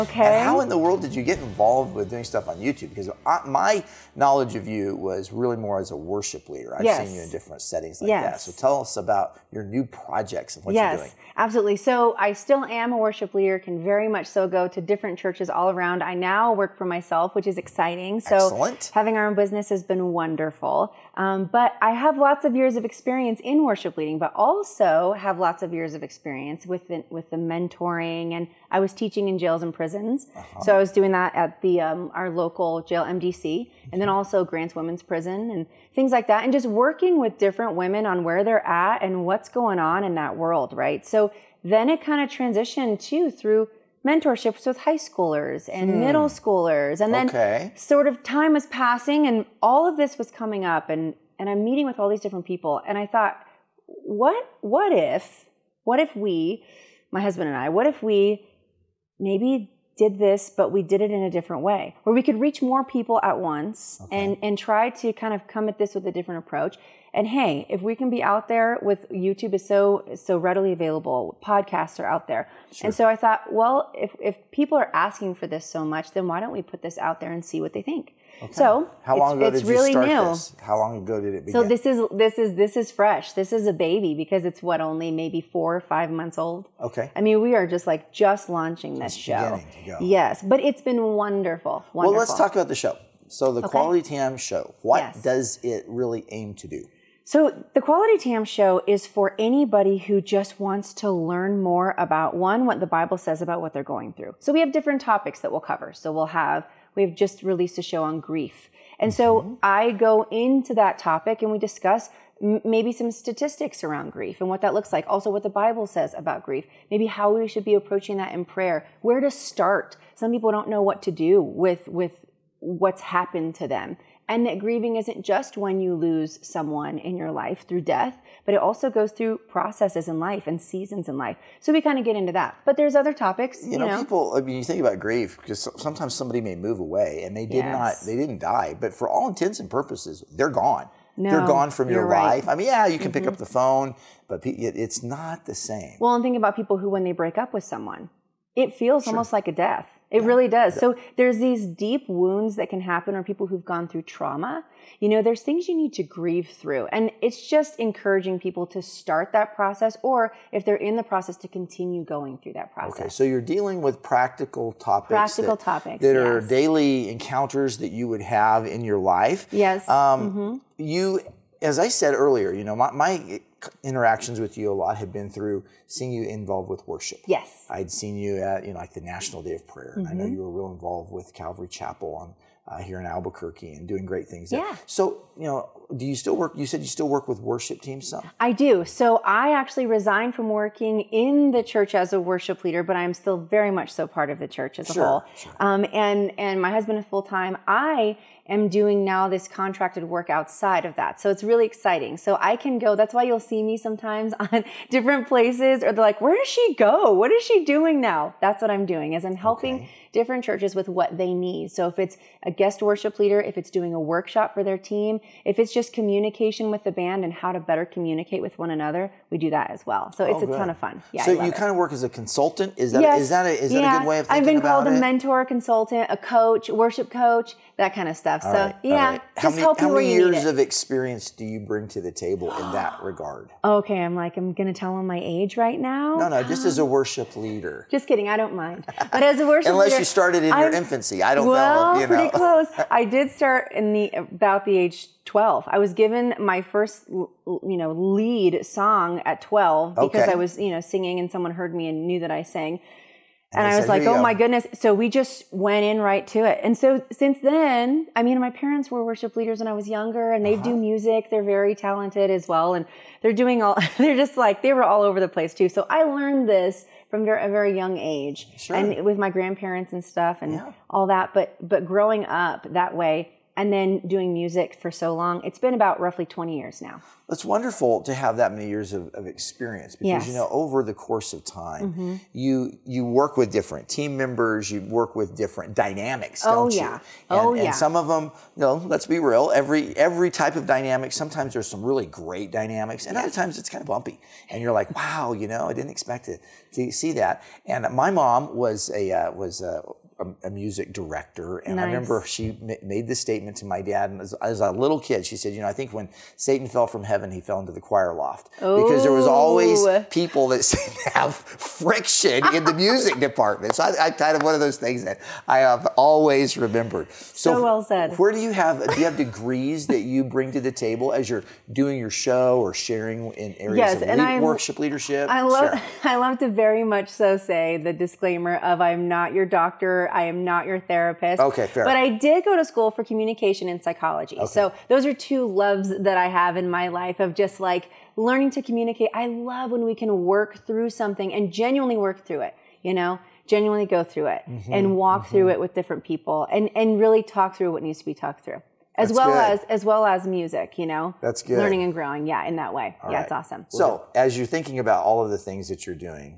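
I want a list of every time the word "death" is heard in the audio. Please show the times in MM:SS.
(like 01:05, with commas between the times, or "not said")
02:07, 02:29.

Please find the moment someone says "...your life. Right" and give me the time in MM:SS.
02:21.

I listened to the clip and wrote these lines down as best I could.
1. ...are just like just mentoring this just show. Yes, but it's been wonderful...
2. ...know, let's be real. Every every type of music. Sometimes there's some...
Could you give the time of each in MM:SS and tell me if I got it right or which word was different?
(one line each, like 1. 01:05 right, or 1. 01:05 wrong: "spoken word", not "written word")
1. 01:27 wrong: "launching", not "mentoring"
2. 04:48 wrong: "dynamic", not "music".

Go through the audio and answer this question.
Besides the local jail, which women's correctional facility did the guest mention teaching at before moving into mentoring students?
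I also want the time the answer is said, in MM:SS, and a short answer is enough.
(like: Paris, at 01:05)
Grants Women's Prison, at 00:34.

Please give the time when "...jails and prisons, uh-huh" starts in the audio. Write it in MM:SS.
00:29.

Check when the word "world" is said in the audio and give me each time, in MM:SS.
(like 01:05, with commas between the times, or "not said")
00:00, 00:40.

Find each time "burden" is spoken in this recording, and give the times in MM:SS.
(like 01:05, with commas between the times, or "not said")
not said.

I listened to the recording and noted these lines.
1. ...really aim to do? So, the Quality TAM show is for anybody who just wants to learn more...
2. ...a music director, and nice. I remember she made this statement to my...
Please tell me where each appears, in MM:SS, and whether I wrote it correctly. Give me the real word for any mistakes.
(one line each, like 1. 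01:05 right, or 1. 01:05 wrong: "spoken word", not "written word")
1. 01:35 right
2. 05:00 right.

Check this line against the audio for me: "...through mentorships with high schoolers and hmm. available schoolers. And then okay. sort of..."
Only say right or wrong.
wrong.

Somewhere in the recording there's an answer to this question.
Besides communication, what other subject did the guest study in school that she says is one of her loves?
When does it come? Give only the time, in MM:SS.
05:33.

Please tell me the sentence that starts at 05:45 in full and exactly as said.
through it with different people and, and really talk through what needs to be talked through as that's well good.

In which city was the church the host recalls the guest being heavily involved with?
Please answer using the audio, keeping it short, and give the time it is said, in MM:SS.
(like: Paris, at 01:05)
Albuquerque, at 03:03.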